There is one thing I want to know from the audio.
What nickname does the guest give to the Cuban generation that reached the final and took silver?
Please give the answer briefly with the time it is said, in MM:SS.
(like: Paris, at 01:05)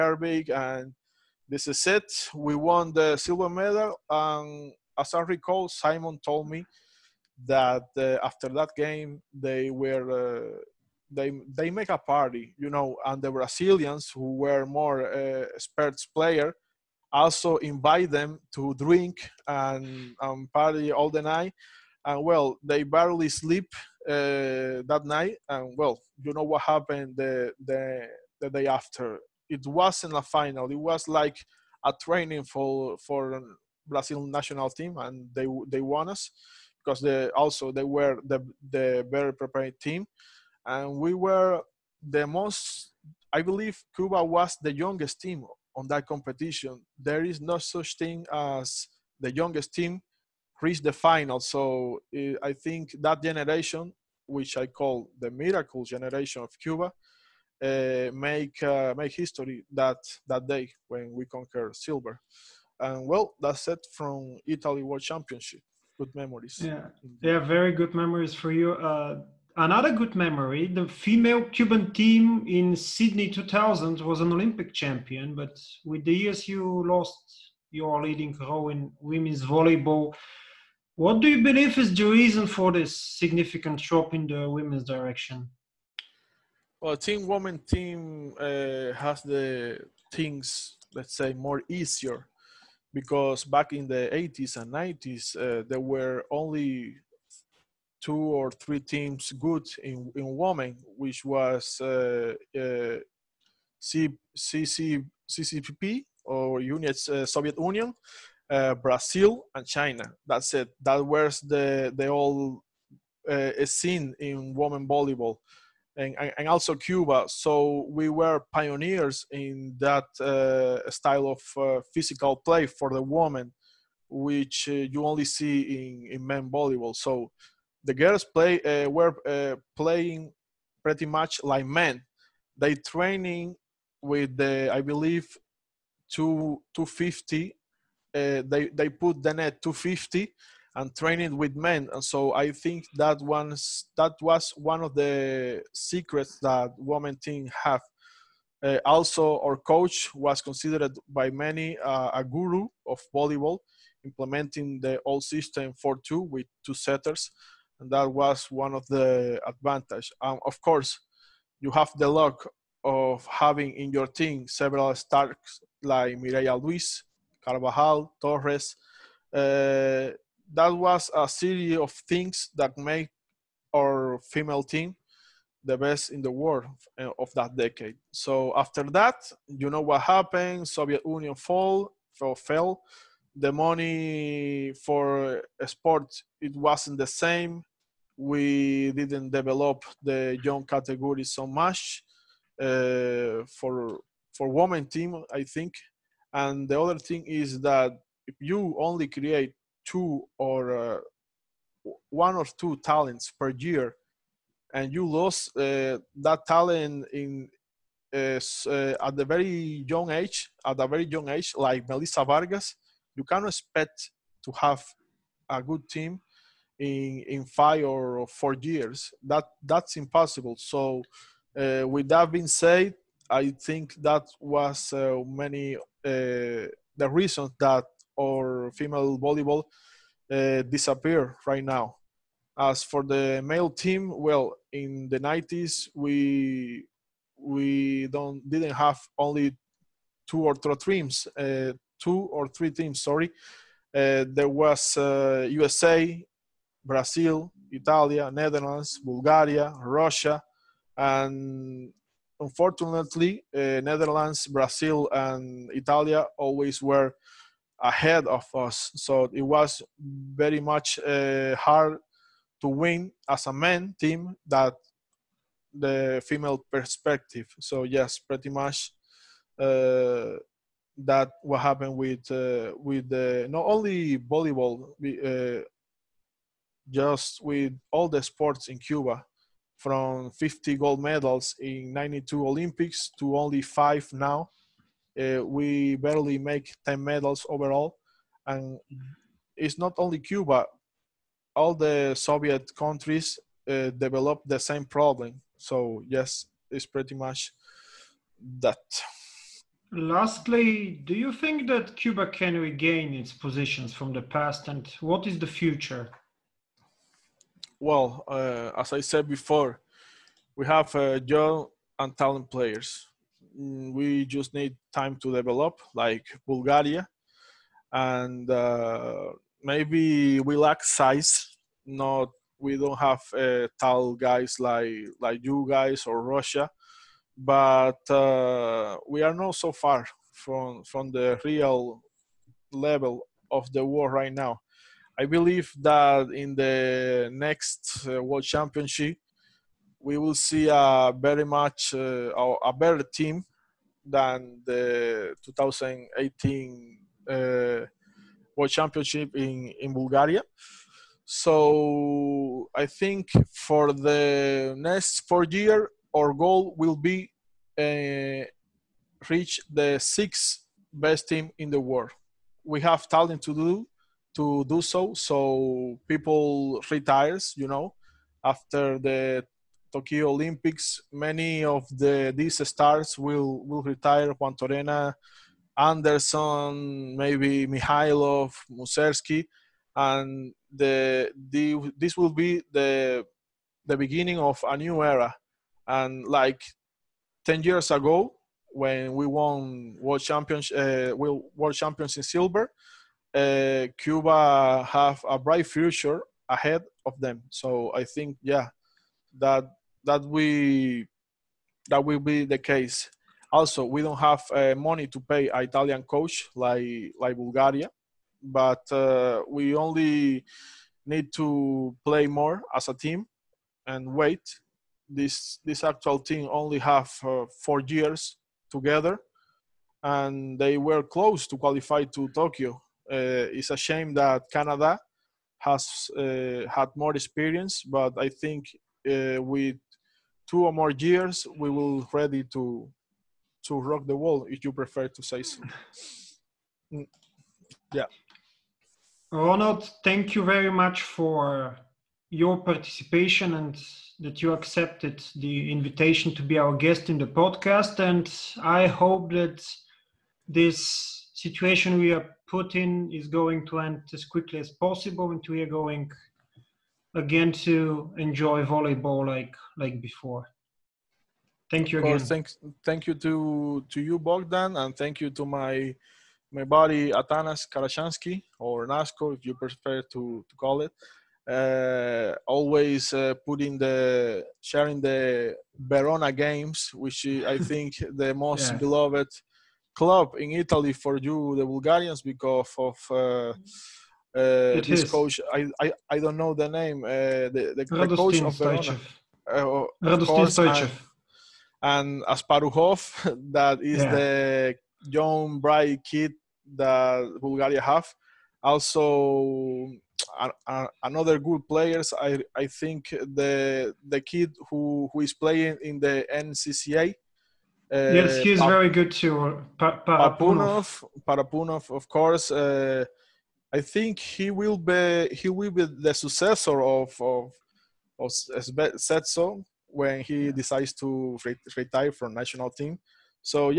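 the miracle generation, at 00:55.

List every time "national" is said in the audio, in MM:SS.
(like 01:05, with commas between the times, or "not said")
00:34, 08:42.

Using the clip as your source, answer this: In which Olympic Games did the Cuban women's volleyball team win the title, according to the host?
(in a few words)
Sydney 2000.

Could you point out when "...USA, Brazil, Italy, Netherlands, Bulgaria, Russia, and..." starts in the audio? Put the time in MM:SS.
04:05.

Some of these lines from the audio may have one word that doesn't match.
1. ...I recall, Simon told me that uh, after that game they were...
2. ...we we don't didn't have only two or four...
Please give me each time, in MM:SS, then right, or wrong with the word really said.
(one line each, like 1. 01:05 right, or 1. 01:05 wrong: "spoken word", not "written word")
1. 00:05 right
2. 03:55 wrong: "three", not "four".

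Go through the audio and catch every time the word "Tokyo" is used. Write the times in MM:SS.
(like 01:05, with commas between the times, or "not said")
06:09, 07:02.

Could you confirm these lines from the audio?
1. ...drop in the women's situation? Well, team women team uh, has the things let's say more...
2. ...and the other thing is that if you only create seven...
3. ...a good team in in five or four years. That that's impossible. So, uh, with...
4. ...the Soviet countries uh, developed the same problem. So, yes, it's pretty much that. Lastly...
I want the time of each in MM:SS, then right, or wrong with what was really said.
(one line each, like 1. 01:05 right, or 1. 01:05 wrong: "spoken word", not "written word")
1. 01:23 wrong: "direction", not "situation"
2. 03:16 wrong: "two", not "seven"
3. 03:35 right
4. 04:51 right.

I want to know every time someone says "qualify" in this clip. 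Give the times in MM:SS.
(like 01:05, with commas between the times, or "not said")
07:01.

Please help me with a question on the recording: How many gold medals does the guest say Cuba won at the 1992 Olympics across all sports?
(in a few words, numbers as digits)
50.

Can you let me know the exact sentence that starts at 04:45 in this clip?
Uh, we barely make 10 medals overall.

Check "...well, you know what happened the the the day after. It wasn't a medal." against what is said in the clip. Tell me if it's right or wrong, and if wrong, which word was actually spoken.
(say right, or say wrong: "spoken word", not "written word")
wrong: "final", not "medal".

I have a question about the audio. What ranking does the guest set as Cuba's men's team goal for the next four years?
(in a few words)
sixth.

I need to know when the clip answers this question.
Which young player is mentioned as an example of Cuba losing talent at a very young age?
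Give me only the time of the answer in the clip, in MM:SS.
03:31.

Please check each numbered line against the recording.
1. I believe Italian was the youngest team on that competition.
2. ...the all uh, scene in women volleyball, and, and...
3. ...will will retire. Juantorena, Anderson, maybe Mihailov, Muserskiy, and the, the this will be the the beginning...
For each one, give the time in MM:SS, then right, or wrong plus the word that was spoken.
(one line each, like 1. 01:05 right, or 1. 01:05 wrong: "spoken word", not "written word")
1. 00:43 wrong: "Cuba", not "Italian"
2. 01:51 right
3. 06:13 right.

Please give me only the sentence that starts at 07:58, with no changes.
beloved club in Italy for you, the Bulgarians, because of uh, mm-hmm.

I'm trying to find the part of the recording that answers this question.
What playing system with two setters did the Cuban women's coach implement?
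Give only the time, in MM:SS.
02:35.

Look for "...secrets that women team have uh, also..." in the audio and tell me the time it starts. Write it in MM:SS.
02:25.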